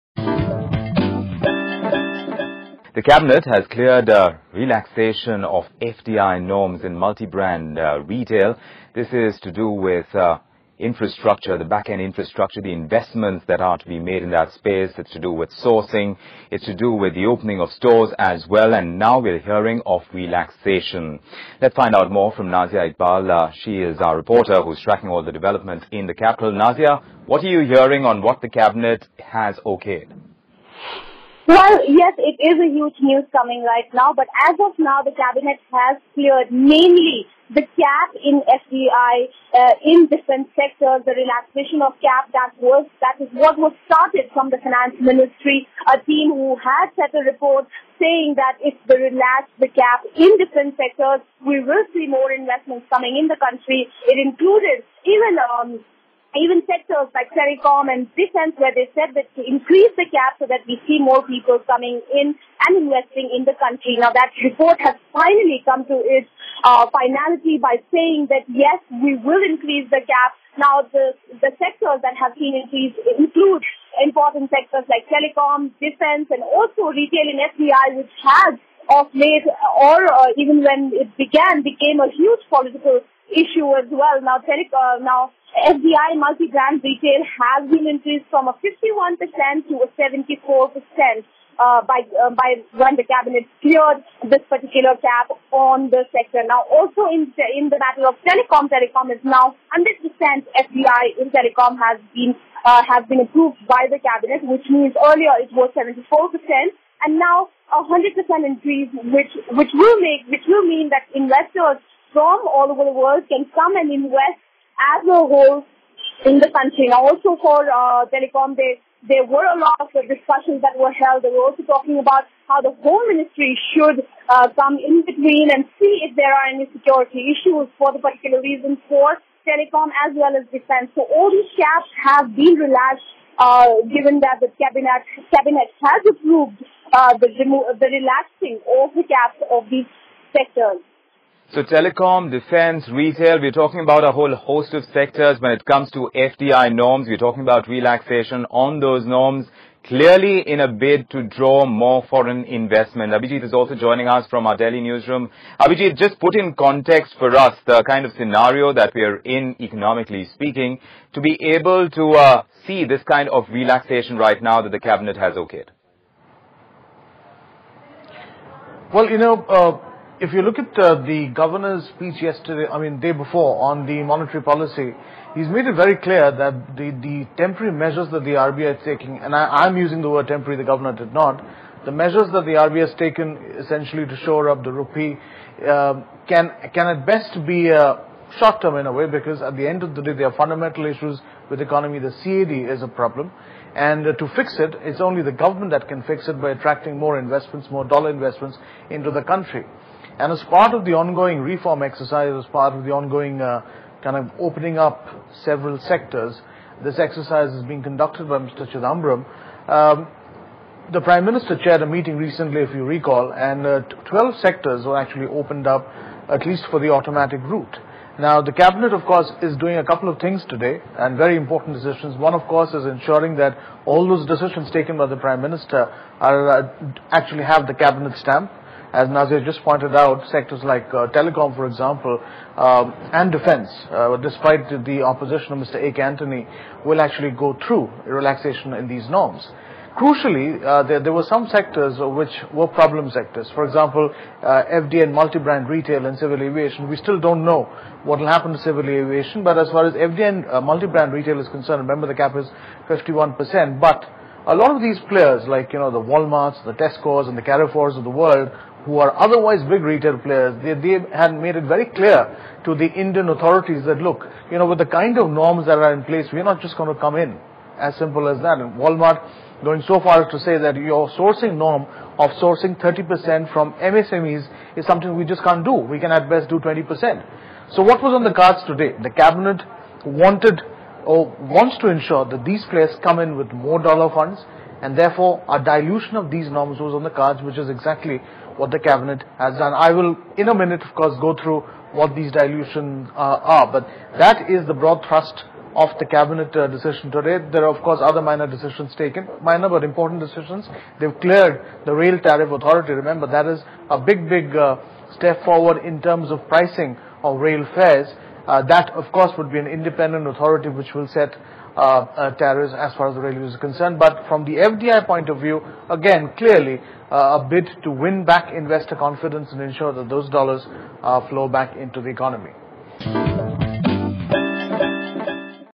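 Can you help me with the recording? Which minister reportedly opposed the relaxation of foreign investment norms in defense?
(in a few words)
A. Antony.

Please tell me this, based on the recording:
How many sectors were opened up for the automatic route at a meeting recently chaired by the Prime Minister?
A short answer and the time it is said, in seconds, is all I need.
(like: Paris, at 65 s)
12, at 213 s.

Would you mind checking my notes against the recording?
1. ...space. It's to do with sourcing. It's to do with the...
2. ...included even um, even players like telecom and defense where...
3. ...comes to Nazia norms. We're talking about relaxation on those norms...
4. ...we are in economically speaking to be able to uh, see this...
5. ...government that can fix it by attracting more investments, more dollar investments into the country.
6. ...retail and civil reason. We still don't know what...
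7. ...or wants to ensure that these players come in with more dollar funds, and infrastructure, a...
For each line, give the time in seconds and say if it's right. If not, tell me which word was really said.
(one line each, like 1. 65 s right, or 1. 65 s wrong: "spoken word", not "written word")
1. 14 s right
2. 54 s wrong: "sectors", not "players"
3. 145 s wrong: "FDI", not "Nazia"
4. 158 s right
5. 195 s right
6. 245 s wrong: "aviation", not "reason"
7. 281 s wrong: "therefore", not "infrastructure".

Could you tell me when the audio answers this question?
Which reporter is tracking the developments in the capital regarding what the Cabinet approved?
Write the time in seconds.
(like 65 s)
22 s.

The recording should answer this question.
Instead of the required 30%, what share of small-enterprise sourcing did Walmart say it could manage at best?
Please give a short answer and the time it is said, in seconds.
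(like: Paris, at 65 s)
20%, at 276 s.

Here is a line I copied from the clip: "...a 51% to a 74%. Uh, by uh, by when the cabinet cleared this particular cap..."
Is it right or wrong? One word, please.
right.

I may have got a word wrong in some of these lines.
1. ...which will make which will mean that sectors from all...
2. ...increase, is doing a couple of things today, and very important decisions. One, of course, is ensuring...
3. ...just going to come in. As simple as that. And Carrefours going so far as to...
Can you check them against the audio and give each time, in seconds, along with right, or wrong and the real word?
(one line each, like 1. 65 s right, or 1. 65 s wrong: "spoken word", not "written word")
1. 109 s wrong: "investors", not "sectors"
2. 219 s wrong: "course", not "increase"
3. 266 s wrong: "Walmart", not "Carrefours".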